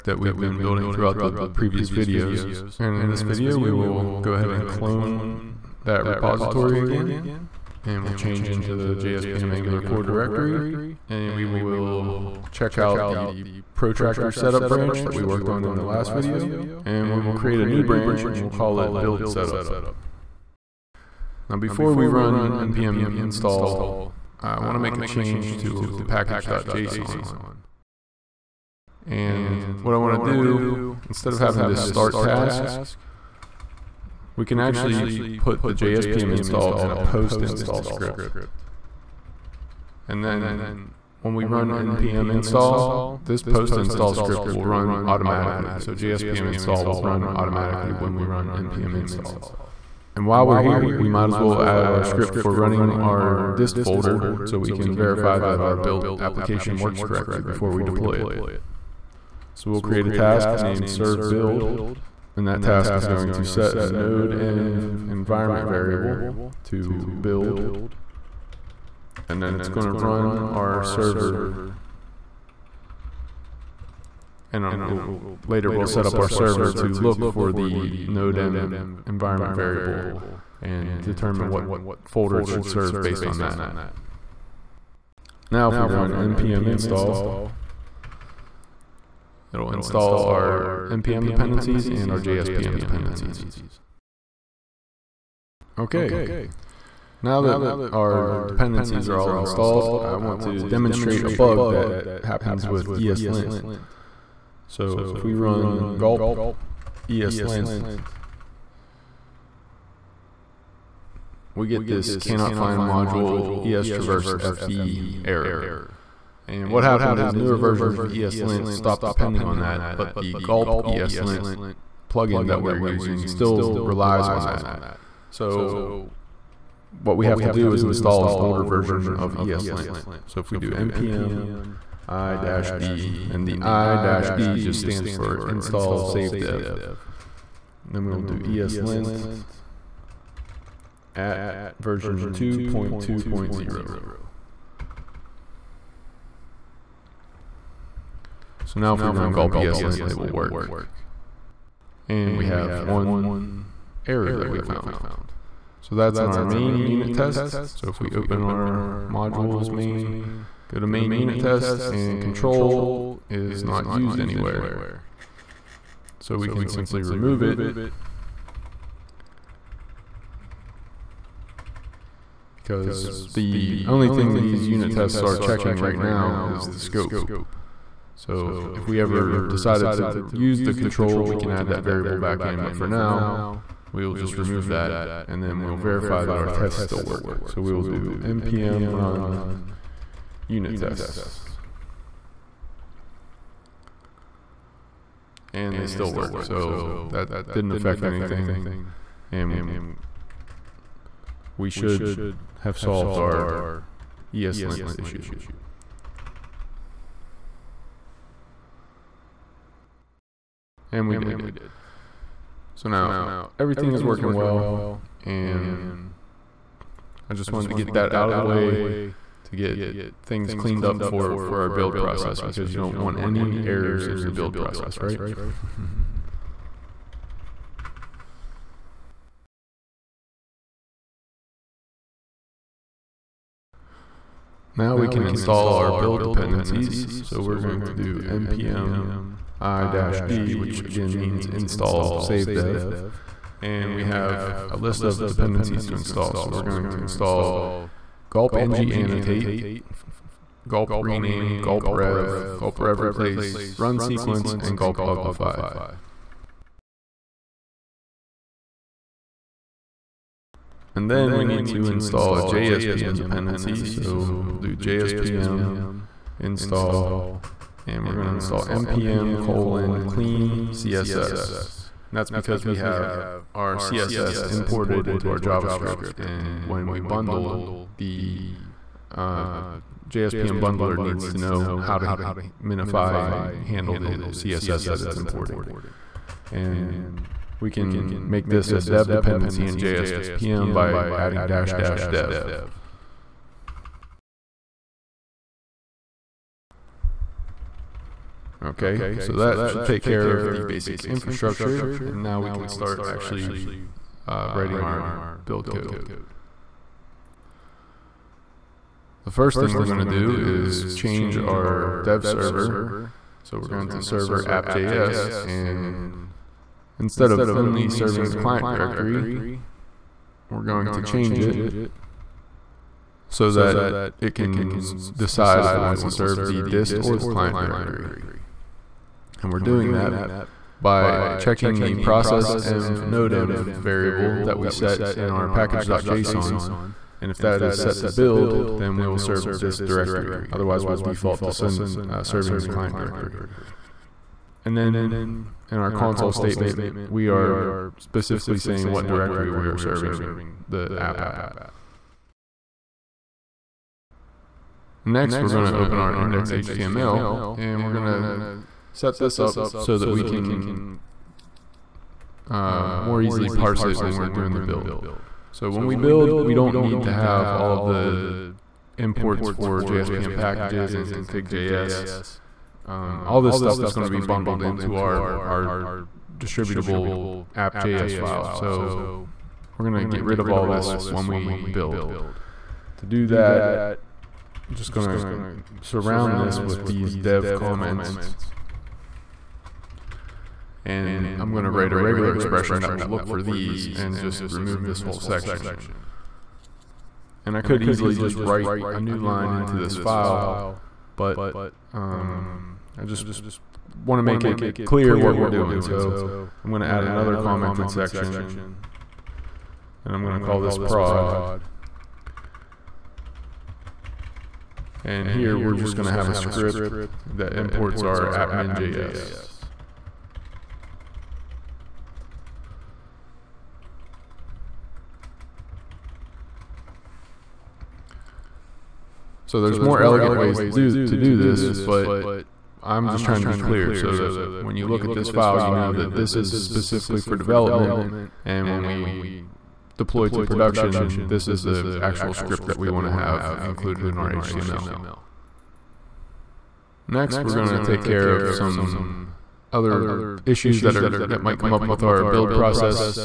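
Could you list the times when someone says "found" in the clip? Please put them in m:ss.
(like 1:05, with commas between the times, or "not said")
2:34.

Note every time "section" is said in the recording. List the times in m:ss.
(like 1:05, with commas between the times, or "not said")
6:35, 6:47.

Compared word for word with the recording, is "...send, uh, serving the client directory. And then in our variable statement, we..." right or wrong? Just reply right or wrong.
wrong.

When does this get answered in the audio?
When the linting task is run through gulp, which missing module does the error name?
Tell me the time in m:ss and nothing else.
1:53.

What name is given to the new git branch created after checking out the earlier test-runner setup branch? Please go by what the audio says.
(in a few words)
build setup.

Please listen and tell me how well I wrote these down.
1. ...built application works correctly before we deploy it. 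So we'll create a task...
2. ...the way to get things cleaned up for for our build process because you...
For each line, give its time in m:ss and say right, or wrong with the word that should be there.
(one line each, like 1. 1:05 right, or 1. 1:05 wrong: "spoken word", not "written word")
1. 0:55 right
2. 3:38 right.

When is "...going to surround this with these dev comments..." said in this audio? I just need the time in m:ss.
6:24.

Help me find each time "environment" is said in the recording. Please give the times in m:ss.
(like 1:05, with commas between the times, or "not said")
1:05, 1:19.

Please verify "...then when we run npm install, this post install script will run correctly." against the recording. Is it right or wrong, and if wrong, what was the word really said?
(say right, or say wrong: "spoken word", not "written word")
wrong: "automatically", not "correctly".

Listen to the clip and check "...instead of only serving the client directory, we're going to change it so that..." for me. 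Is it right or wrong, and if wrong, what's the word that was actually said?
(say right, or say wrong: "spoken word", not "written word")
right.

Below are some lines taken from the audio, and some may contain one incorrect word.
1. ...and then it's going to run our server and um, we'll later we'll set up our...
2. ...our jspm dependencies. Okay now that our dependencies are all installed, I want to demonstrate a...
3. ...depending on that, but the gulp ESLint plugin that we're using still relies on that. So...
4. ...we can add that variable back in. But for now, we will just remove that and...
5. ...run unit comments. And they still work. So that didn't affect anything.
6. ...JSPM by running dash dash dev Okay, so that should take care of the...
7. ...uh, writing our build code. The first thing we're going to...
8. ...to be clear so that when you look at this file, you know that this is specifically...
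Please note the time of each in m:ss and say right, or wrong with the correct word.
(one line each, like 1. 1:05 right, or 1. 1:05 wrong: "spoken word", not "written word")
1. 1:09 right
2. 1:32 right
3. 1:59 right
4. 3:01 right
5. 3:08 wrong: "tests", not "comments"
6. 4:49 wrong: "adding", not "running"
7. 5:04 right
8. 7:13 right.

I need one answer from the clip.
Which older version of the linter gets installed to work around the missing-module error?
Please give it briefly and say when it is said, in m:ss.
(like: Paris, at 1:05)
2.2.0, at 2:22.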